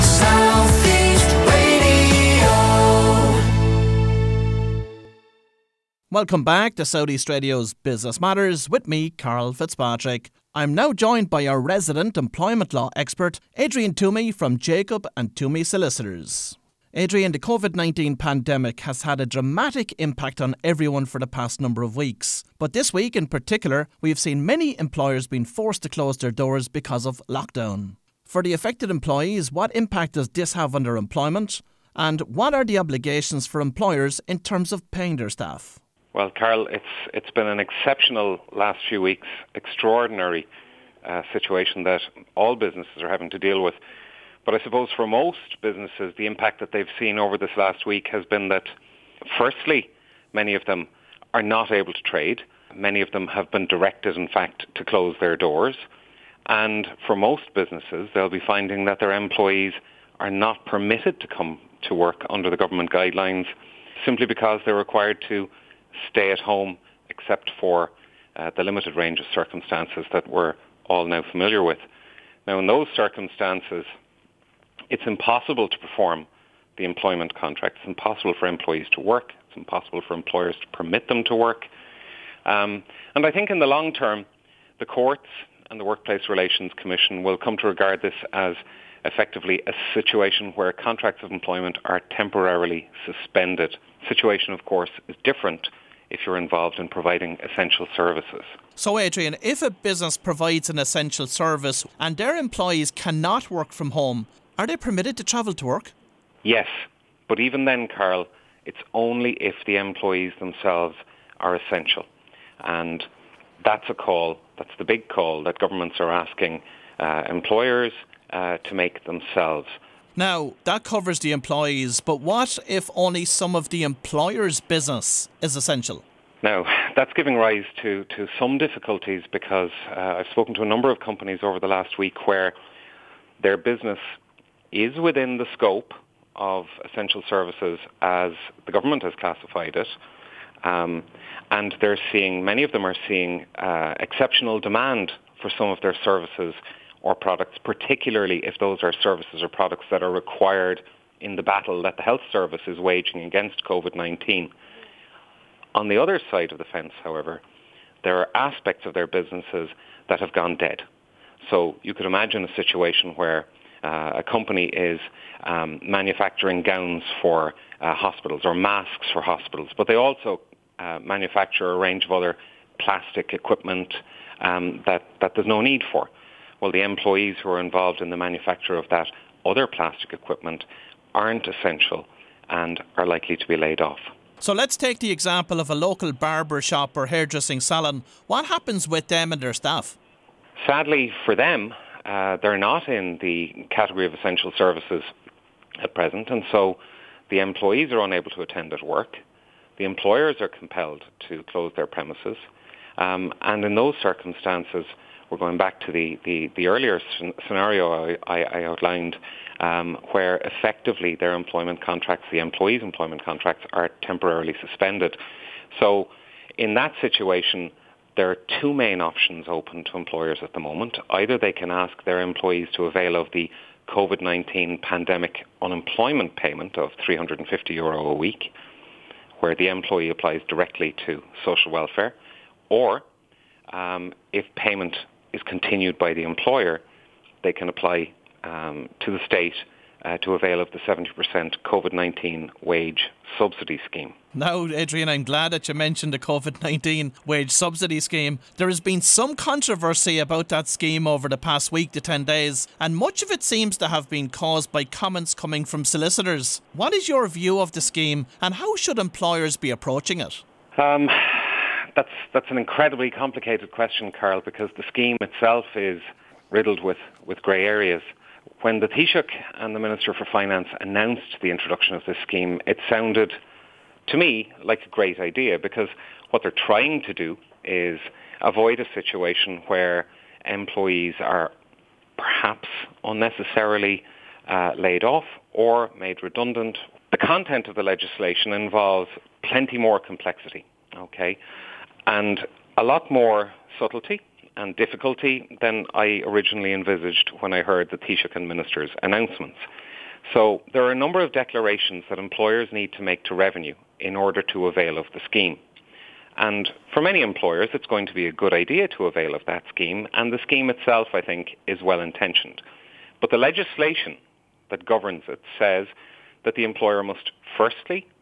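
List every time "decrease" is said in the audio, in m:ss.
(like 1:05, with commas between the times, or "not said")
not said.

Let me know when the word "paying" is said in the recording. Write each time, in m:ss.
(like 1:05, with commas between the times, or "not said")
0:34.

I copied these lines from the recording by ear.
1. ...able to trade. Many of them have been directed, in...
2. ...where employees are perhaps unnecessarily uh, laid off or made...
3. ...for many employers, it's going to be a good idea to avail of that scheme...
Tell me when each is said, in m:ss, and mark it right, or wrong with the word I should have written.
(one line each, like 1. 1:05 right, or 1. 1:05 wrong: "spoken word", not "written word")
1. 0:51 right
2. 4:39 right
3. 5:06 right.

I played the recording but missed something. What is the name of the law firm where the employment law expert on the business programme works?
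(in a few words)
Jacob and Twomey Solicitors.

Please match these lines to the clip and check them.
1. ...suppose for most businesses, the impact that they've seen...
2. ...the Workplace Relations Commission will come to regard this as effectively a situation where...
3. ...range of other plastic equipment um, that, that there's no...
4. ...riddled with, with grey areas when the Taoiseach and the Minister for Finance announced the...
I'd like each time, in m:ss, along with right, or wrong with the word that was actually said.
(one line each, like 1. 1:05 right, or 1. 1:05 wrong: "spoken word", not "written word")
1. 0:44 right
2. 1:25 right
3. 2:51 right
4. 4:26 right.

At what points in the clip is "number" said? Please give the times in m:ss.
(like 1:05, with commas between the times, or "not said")
0:21, 2:10, 5:00.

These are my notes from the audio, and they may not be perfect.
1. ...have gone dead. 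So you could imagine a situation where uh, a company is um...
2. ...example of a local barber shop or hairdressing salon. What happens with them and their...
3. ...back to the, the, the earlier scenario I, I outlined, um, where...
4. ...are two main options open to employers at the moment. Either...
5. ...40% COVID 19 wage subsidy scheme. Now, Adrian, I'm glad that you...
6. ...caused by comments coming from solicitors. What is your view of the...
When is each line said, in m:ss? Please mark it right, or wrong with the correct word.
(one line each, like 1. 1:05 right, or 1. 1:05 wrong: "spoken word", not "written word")
1. 2:40 right
2. 3:05 right
3. 3:25 right
4. 3:38 right
5. 4:00 wrong: "70", not "40"
6. 4:14 right.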